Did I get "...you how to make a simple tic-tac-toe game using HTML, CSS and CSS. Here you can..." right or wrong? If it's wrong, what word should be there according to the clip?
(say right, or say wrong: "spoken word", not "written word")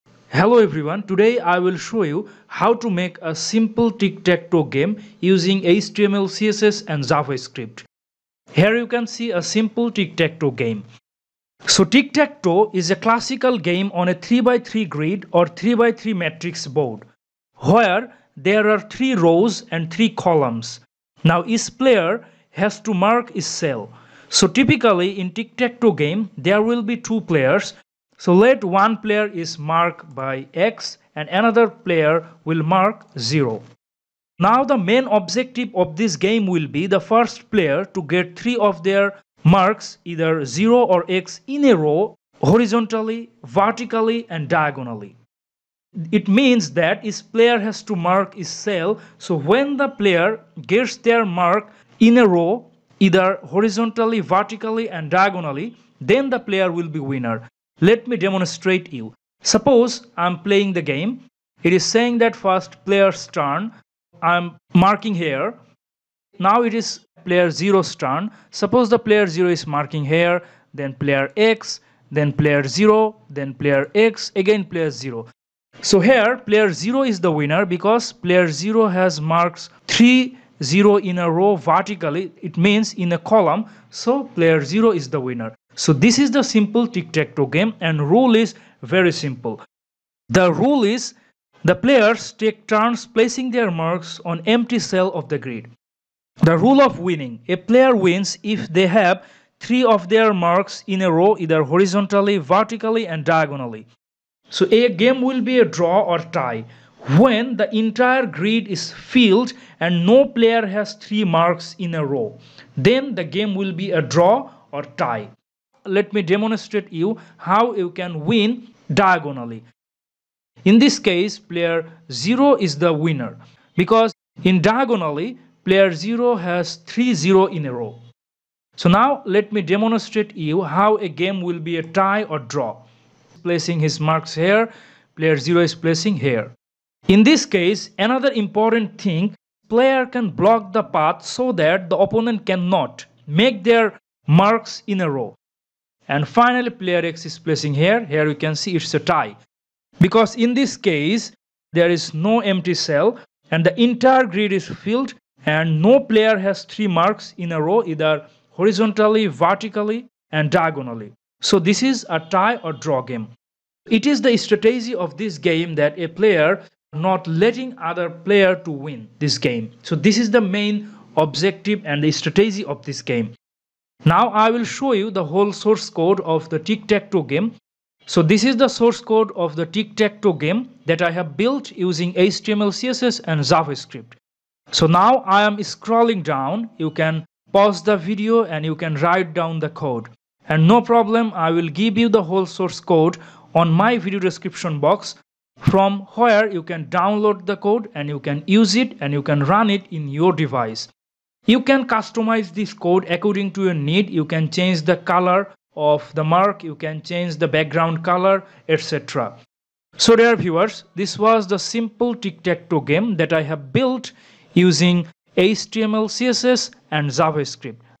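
wrong: "JavaScript", not "CSS".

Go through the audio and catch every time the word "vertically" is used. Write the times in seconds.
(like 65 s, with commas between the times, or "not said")
43 s, 54 s, 81 s, 102 s, 159 s.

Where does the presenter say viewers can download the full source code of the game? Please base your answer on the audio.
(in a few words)
Video description box.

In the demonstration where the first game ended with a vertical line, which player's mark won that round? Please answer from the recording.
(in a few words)
Player 0.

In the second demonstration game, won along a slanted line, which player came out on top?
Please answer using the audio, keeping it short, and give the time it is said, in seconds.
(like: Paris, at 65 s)
Player 0, at 121 s.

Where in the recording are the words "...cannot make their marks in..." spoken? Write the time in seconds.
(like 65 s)
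142 s.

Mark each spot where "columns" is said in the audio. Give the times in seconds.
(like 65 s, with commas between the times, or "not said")
20 s, 83 s.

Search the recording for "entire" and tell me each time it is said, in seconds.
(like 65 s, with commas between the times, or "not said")
107 s, 153 s.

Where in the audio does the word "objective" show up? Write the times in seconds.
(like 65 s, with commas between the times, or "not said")
35 s, 171 s.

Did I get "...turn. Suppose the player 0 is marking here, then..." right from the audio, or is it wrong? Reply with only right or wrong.
right.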